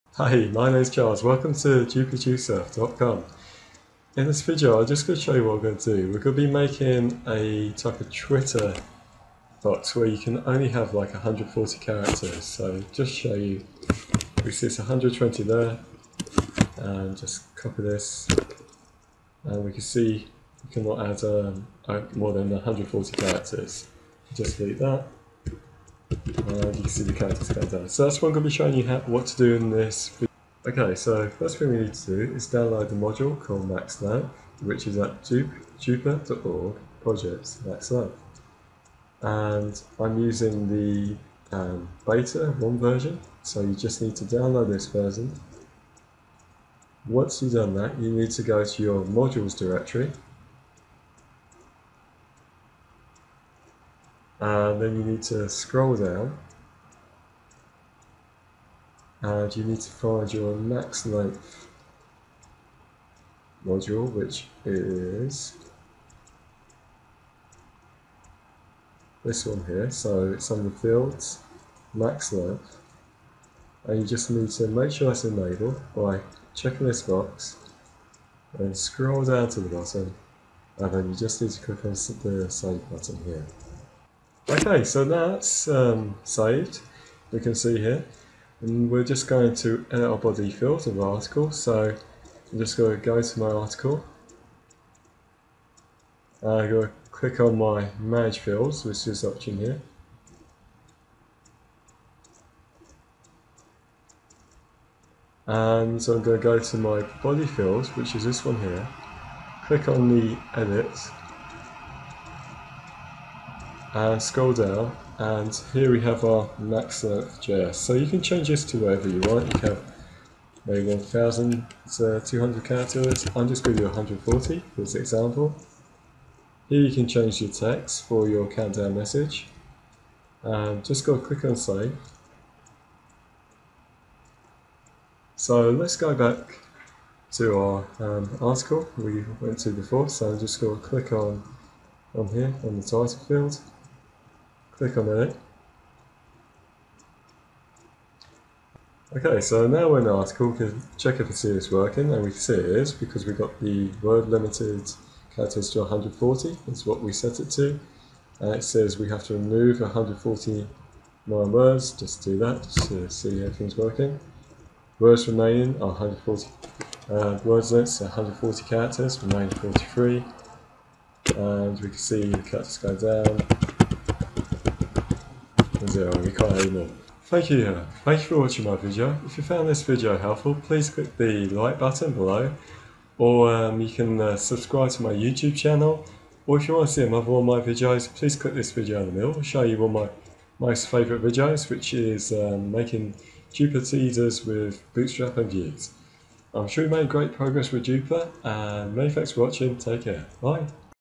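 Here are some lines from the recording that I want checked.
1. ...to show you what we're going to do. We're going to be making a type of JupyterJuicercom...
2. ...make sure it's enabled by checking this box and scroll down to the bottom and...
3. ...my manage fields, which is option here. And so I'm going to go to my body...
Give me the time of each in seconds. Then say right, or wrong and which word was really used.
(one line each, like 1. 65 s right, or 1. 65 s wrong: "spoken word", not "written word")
1. 5 s wrong: "Twitter", not "JupyterJuicercom"
2. 74 s right
3. 97 s right.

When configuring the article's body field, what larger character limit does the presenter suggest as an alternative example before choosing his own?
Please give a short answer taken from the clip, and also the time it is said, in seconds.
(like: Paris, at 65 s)
1,200, at 120 s.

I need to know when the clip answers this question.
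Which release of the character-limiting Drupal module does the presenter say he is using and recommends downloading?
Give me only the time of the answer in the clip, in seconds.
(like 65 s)
42 s.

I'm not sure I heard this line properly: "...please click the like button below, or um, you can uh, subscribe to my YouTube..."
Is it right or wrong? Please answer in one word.
right.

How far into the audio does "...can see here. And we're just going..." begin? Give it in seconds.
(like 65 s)
87 s.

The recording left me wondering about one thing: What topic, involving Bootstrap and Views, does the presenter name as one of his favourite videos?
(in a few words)
Drupal teasers.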